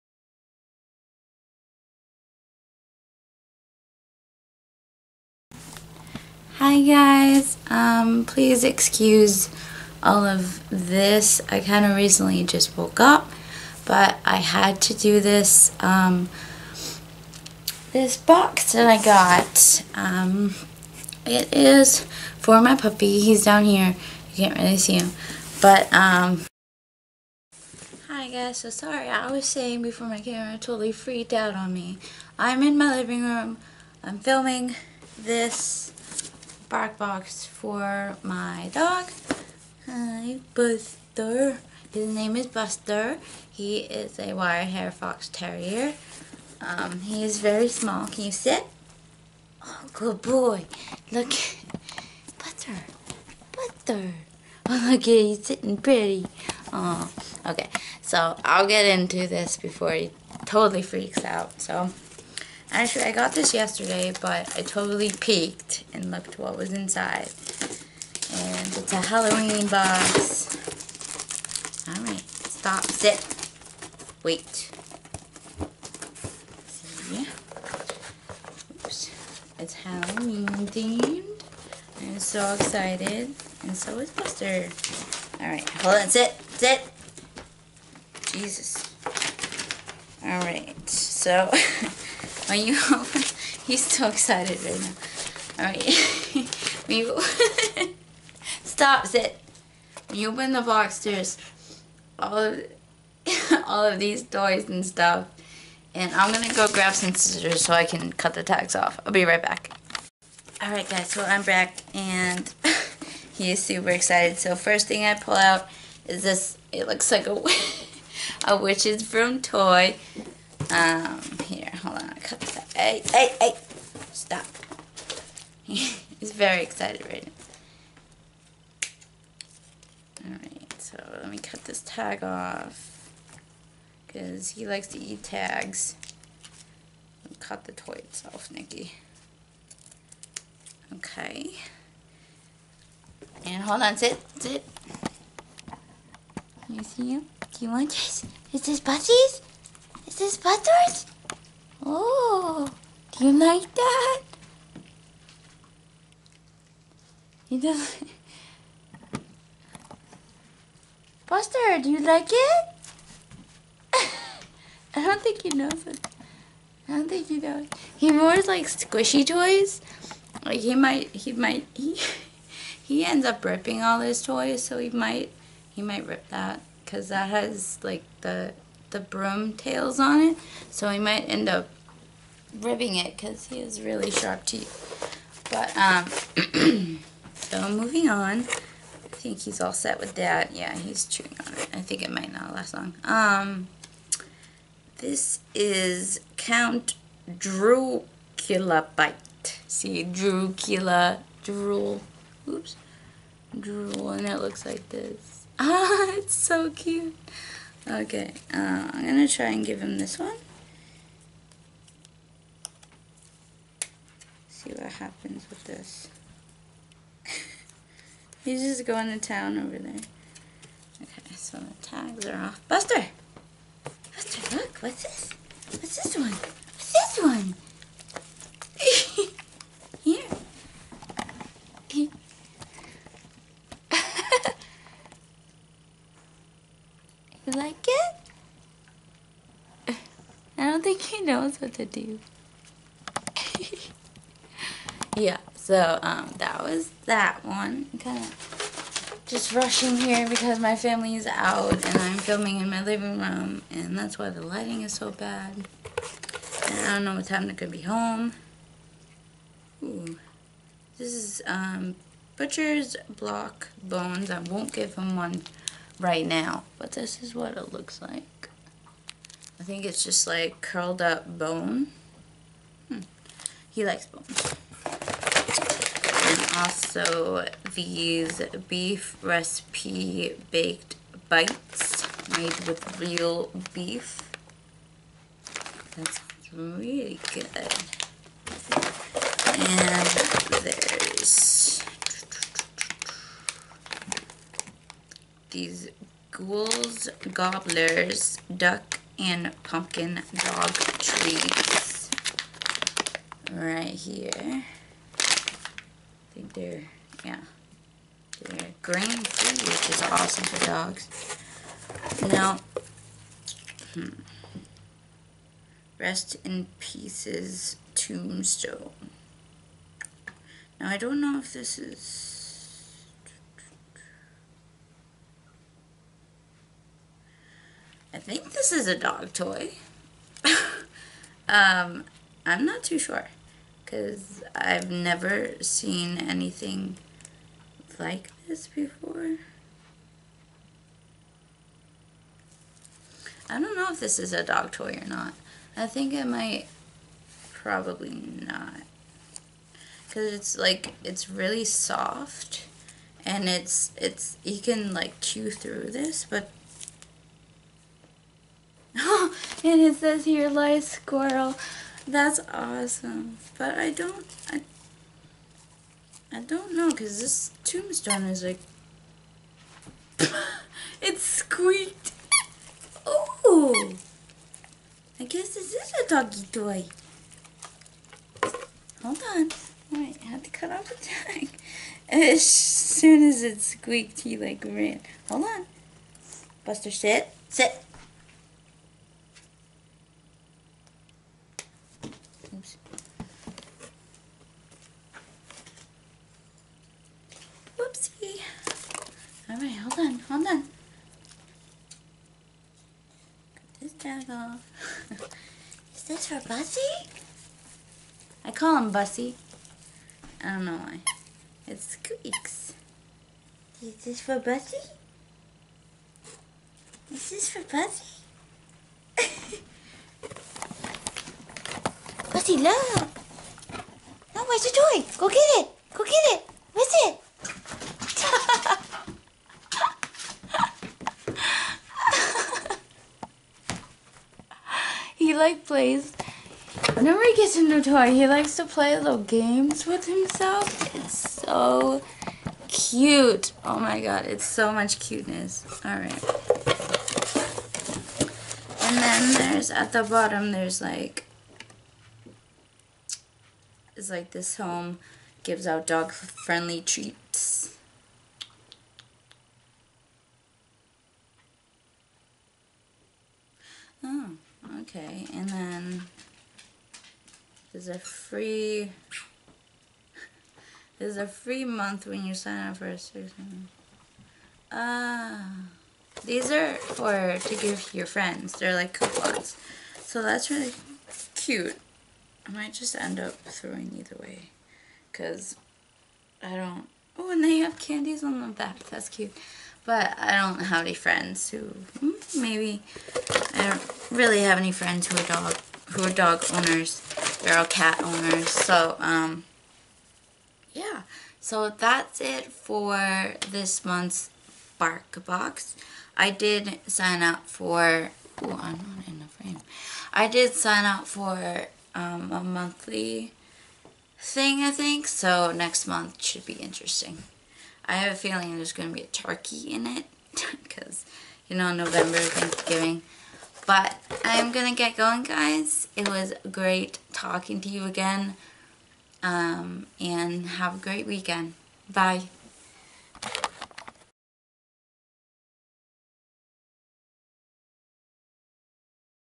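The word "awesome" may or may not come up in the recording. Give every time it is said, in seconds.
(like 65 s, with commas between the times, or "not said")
310 s, 362 s.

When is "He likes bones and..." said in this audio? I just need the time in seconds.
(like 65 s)
273 s.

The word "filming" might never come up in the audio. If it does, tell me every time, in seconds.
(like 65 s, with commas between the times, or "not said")
34 s, 252 s.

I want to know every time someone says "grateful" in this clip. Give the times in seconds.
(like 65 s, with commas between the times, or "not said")
not said.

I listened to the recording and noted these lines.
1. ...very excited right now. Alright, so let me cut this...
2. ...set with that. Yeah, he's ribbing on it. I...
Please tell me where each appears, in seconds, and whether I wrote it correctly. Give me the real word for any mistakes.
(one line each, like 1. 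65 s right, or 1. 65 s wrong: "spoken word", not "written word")
1. 126 s right
2. 189 s wrong: "chewing", not "ribbing".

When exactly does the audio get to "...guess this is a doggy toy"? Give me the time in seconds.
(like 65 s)
375 s.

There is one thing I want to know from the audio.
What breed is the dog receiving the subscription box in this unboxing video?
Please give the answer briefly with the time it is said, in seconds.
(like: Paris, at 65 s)
Wire hair fox terrier, at 44 s.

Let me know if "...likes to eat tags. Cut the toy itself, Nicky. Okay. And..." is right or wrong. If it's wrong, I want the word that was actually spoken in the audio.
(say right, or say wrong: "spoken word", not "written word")
right.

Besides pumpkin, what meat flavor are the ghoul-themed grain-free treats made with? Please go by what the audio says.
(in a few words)
Duck.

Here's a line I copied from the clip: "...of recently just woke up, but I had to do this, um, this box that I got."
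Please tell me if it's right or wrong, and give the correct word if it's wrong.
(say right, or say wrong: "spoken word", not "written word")
right.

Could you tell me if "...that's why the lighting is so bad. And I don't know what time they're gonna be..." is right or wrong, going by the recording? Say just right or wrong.
right.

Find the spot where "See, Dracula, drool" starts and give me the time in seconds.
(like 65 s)
199 s.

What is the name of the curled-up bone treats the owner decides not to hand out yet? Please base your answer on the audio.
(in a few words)
Butcher's block bones.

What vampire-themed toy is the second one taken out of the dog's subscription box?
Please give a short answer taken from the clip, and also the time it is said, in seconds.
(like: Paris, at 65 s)
Count Dracula Bite, at 196 s.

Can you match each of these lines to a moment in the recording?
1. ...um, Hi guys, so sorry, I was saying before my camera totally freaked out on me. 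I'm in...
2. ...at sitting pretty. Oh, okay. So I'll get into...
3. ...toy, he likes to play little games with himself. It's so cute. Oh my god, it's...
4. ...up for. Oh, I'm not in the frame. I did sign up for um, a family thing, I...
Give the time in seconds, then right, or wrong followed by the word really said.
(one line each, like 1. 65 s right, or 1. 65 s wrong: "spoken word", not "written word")
1. 25 s right
2. 55 s right
3. 437 s right
4. 507 s wrong: "monthly", not "family".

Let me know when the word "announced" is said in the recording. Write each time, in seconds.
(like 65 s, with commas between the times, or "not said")
not said.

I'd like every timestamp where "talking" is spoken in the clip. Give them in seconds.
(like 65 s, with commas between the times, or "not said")
527 s.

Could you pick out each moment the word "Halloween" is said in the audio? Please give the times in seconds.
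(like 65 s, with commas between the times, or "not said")
69 s, 79 s.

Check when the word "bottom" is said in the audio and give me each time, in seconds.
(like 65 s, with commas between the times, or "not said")
450 s.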